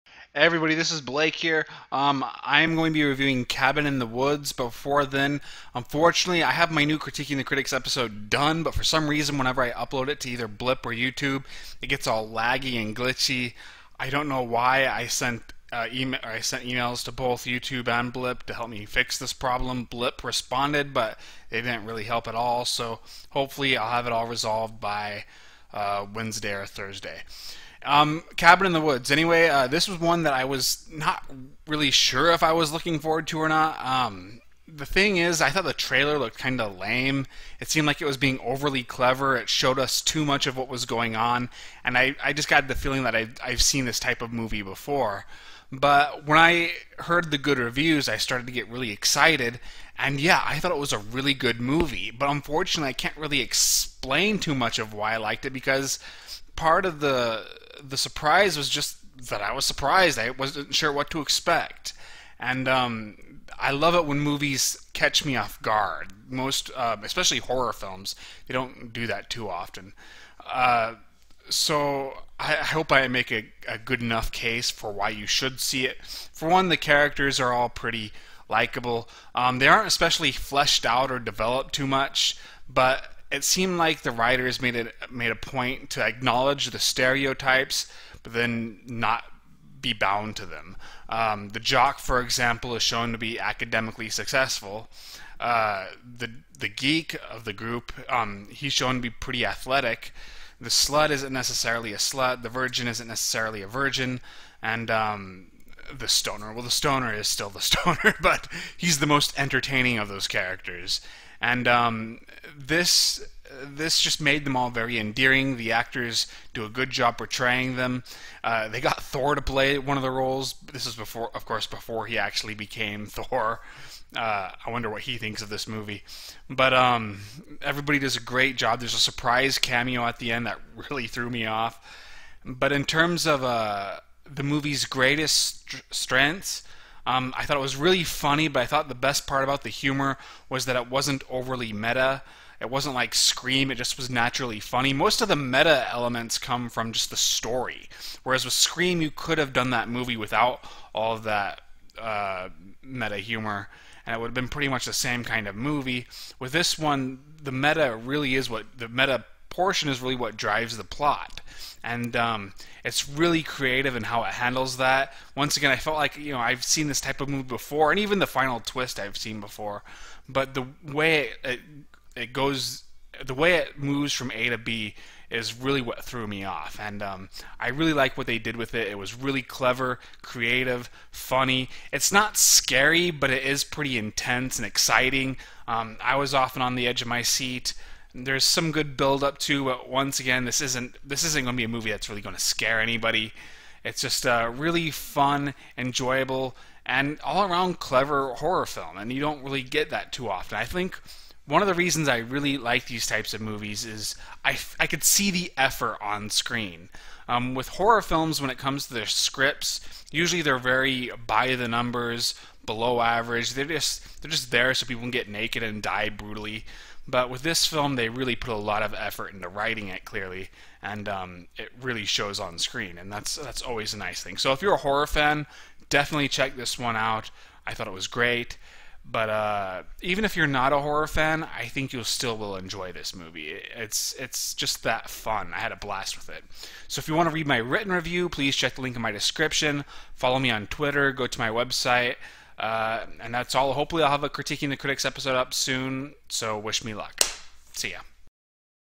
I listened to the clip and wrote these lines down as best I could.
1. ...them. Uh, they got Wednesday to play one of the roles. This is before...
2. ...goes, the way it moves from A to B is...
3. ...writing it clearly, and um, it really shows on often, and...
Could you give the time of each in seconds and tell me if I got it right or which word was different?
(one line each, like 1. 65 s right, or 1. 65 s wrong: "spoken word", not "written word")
1. 117 s wrong: "Thor", not "Wednesday"
2. 172 s right
3. 219 s wrong: "screen", not "often".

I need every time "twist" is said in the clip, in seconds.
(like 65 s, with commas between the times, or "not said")
168 s.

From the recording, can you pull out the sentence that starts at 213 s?
They're just they're just there so people can get naked and die brutally.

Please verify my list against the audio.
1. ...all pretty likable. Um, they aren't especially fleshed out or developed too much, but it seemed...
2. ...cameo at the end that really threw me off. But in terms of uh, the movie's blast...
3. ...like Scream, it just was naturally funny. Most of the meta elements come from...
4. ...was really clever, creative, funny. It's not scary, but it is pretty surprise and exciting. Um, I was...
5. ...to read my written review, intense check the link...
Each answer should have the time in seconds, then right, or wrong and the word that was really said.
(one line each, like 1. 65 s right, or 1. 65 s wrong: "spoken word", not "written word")
1. 77 s right
2. 129 s wrong: "greatest", not "blast"
3. 142 s right
4. 178 s wrong: "intense", not "surprise"
5. 237 s wrong: "please", not "intense".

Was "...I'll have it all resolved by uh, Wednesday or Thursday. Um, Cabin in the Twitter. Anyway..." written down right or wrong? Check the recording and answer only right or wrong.
wrong.